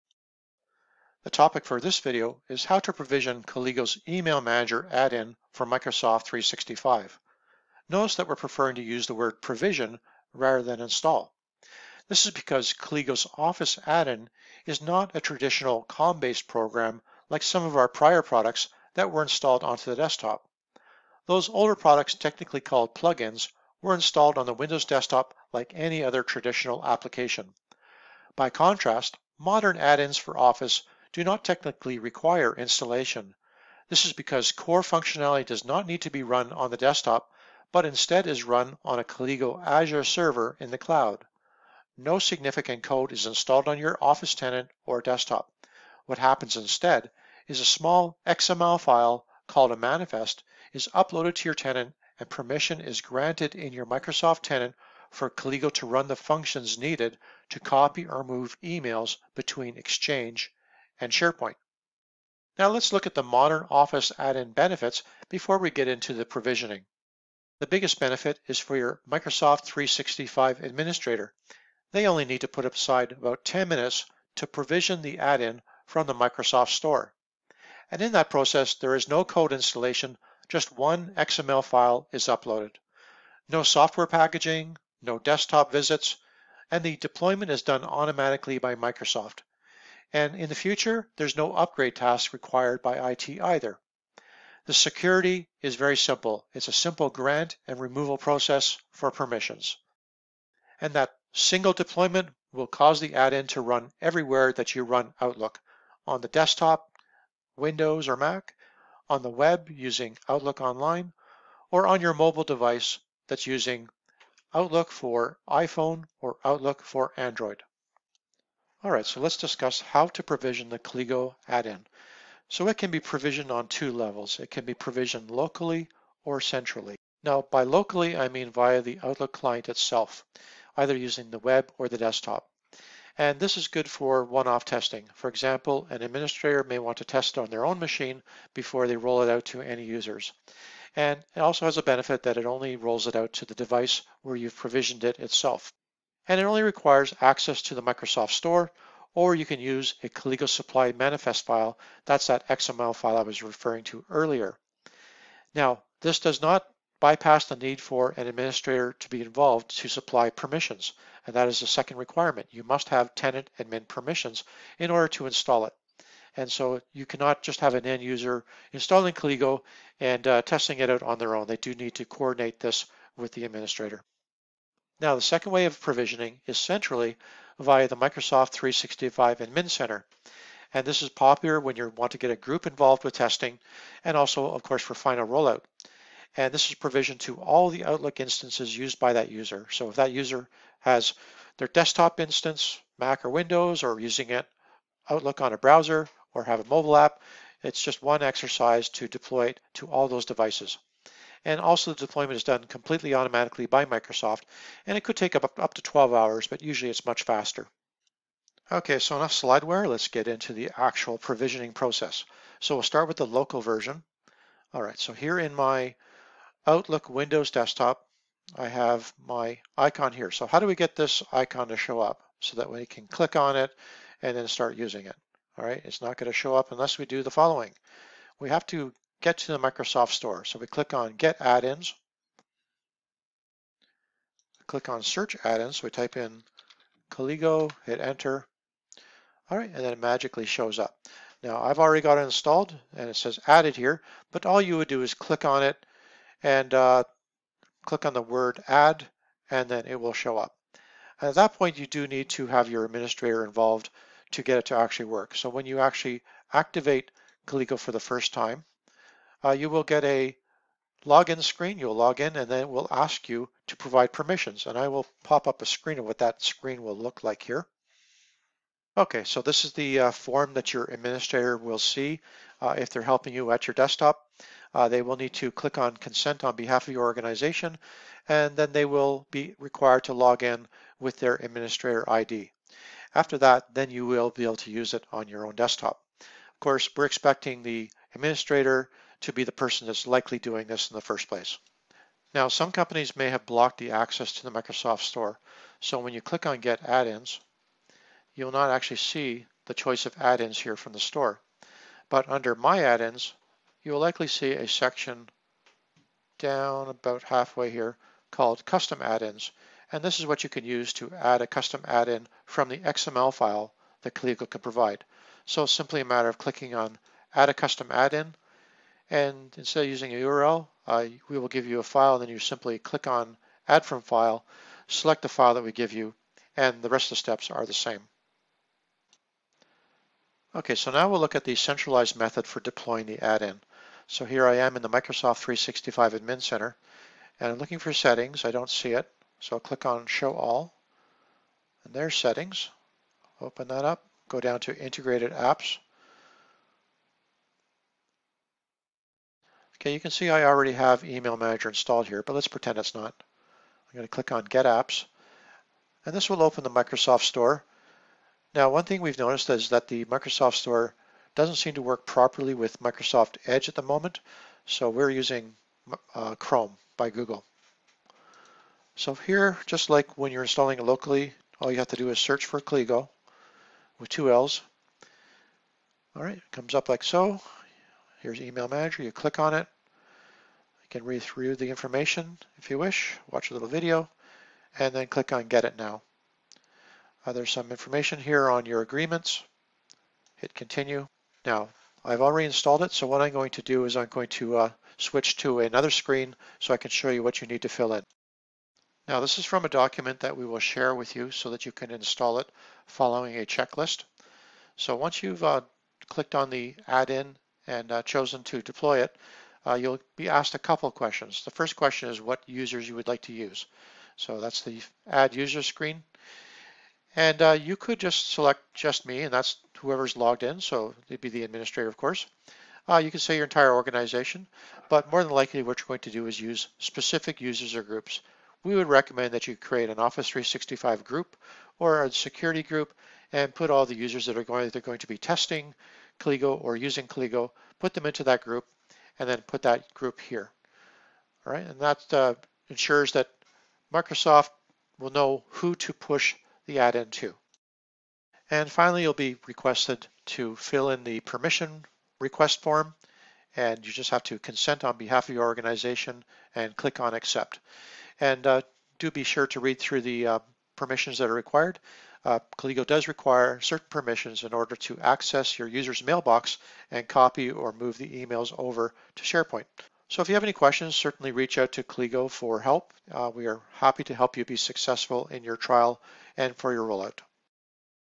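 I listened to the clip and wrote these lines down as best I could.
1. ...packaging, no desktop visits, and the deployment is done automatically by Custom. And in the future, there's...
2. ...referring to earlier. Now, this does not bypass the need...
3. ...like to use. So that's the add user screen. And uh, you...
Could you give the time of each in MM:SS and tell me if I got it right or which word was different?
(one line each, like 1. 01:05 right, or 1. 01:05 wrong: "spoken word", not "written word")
1. 01:24 wrong: "Microsoft", not "Custom"
2. 02:33 right
3. 06:53 right.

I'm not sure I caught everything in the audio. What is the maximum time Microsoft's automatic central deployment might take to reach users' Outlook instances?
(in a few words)
12 hours.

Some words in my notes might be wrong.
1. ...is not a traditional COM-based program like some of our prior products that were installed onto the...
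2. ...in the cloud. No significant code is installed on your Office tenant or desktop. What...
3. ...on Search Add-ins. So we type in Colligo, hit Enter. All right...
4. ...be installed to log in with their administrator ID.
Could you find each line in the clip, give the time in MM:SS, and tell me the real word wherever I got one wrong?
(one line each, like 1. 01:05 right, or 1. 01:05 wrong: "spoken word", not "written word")
1. 00:14 right
2. 00:40 right
3. 03:54 right
4. 04:39 wrong: "required", not "installed".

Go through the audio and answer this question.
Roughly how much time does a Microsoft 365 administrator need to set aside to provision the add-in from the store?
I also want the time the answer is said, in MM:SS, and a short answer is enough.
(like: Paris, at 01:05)
10 minutes, at 01:13.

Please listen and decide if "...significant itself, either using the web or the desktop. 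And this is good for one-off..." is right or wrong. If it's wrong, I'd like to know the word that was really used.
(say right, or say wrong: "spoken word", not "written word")
wrong: "client", not "significant".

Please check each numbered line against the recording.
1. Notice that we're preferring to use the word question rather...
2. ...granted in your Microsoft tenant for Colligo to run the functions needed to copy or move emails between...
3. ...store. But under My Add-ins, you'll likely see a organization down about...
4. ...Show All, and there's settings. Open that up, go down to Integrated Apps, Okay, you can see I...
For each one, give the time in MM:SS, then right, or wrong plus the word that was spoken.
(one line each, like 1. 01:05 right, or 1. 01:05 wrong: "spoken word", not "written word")
1. 00:07 wrong: "provision", not "question"
2. 00:53 right
3. 05:00 wrong: "section", not "organization"
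4. 05:40 right.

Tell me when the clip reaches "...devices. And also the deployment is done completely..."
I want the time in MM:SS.
03:20.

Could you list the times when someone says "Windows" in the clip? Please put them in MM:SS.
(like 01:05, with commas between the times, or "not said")
00:24, 01:47, 03:13, 03:37.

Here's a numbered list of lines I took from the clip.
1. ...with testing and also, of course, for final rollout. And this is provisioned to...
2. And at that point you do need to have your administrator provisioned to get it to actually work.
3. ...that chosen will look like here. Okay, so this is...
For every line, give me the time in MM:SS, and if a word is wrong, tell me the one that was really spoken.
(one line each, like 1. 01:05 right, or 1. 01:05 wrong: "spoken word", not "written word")
1. 03:03 right
2. 04:11 wrong: "involved", not "provisioned"
3. 04:26 wrong: "screen", not "chosen".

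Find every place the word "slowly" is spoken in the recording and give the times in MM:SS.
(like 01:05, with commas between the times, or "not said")
not said.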